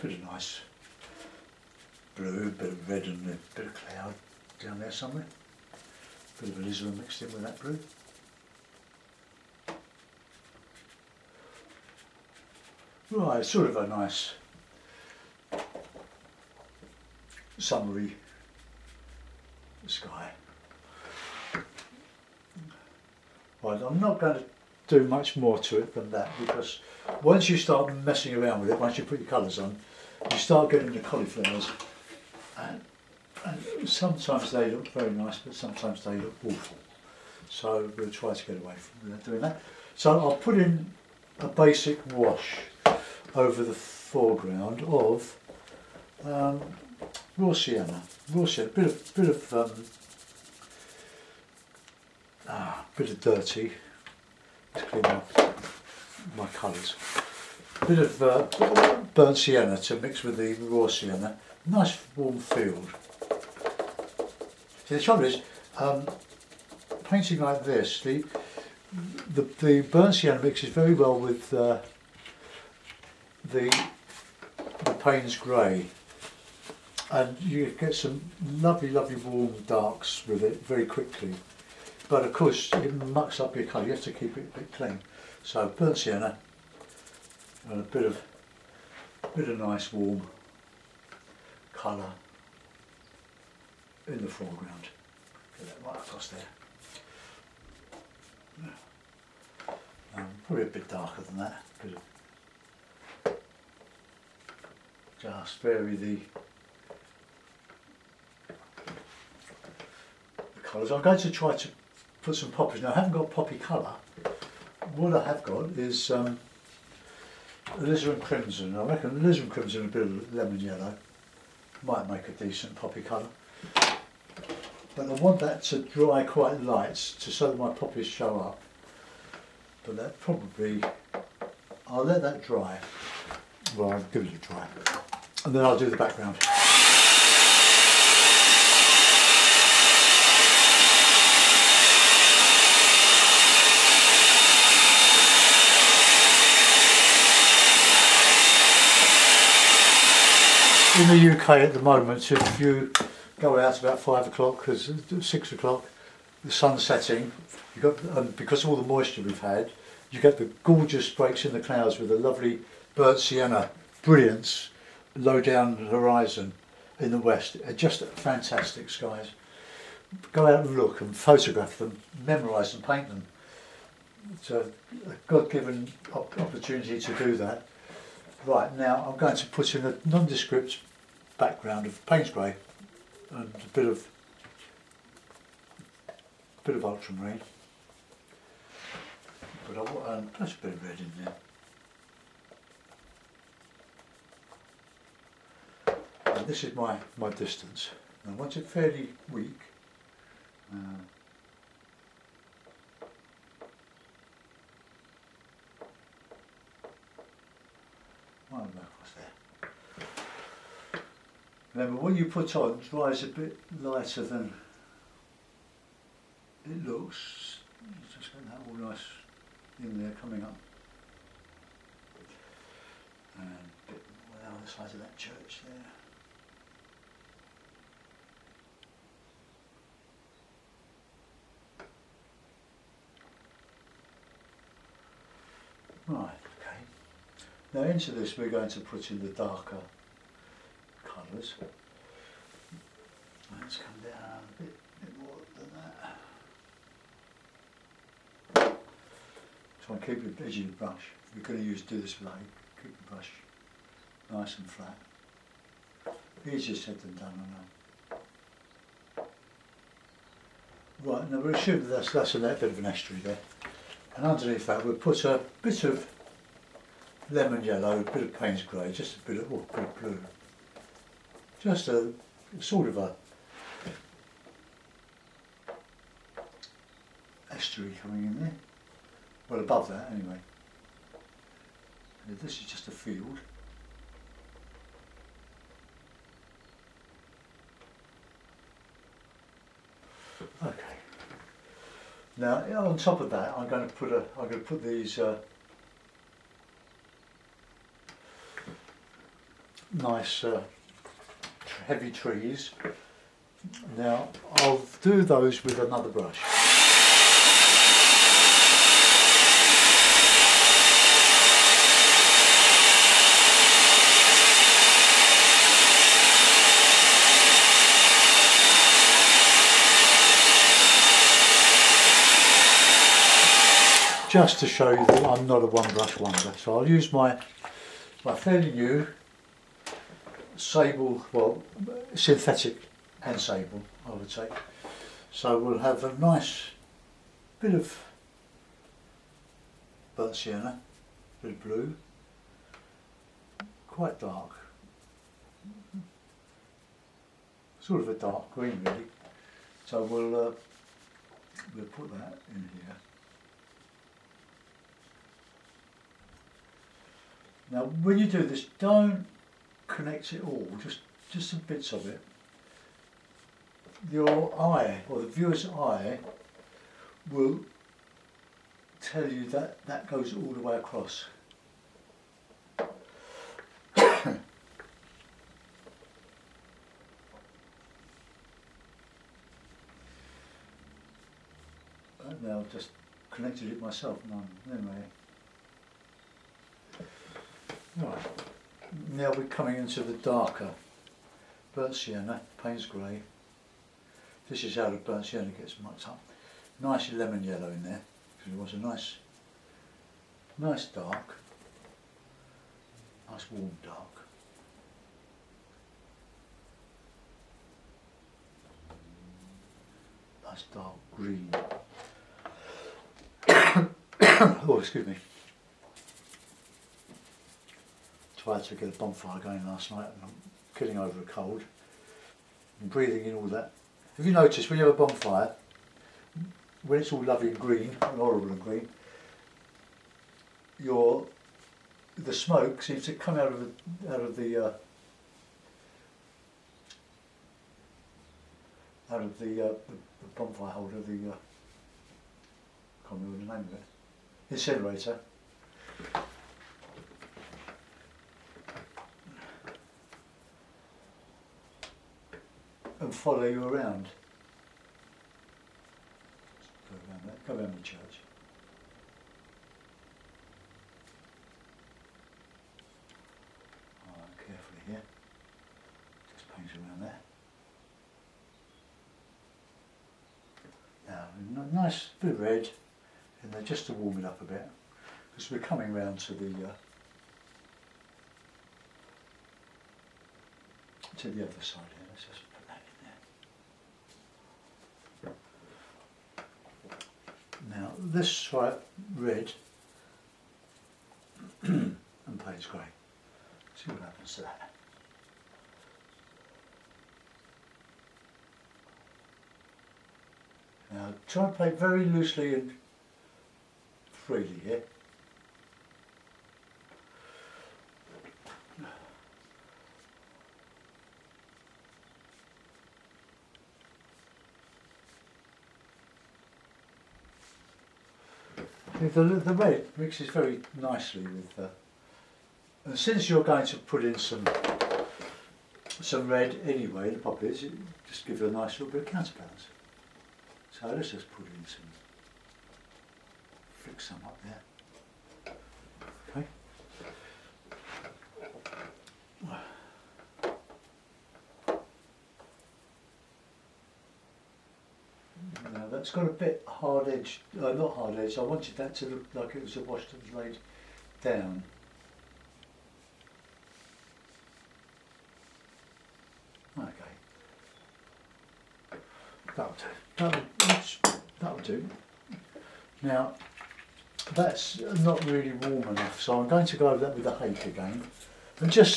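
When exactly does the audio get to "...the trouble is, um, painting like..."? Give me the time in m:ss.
1:04.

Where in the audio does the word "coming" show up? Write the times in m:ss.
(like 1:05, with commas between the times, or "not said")
3:40, 4:38, 6:29, 7:55.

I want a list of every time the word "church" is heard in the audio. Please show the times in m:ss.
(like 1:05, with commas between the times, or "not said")
3:45, 7:37.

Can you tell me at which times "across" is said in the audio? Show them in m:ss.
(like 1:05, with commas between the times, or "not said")
1:35, 6:10.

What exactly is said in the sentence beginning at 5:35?
So we'll have a nice bit of burnt sienna, a bit of blue, quite dark, sort of a dark green really.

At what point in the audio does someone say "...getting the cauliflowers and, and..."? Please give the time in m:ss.
0:30.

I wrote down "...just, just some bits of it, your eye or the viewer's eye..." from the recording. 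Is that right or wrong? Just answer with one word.
right.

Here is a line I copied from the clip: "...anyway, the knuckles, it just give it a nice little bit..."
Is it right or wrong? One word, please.
wrong.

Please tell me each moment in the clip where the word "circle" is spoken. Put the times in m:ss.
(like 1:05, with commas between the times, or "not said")
not said.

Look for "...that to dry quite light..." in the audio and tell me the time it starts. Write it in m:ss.
2:05.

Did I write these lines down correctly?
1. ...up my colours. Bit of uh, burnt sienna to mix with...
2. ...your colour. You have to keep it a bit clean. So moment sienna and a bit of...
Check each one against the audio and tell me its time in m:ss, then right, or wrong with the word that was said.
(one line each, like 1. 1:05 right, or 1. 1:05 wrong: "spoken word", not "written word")
1. 0:55 right
2. 1:23 wrong: "burnt", not "moment".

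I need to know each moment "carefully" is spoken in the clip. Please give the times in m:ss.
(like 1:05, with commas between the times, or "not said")
7:44.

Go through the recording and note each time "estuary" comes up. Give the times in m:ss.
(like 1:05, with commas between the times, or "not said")
4:22, 4:37.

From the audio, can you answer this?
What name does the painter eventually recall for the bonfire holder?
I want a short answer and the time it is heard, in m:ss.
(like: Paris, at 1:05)
Incinerator, at 7:24.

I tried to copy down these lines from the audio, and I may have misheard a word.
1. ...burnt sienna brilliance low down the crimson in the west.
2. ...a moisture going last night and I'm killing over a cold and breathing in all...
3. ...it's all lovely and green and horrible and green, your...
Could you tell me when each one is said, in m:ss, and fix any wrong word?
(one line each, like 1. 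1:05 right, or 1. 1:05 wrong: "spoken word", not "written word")
1. 2:42 wrong: "horizon", not "crimson"
2. 6:58 wrong: "bonfire", not "moisture"
3. 7:06 right.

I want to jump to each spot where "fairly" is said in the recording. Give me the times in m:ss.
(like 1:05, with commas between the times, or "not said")
3:18, 5:28.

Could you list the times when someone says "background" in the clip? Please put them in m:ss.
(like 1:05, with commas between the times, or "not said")
2:15, 3:01.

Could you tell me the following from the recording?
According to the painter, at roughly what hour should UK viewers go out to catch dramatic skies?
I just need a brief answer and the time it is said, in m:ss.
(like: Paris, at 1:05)
5 o'clock, at 2:33.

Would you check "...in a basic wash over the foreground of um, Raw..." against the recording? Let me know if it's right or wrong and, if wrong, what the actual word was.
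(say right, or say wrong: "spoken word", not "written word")
right.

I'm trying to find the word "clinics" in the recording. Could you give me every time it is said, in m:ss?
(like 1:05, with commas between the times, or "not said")
not said.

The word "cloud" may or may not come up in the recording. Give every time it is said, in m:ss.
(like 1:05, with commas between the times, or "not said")
0:03, 2:41.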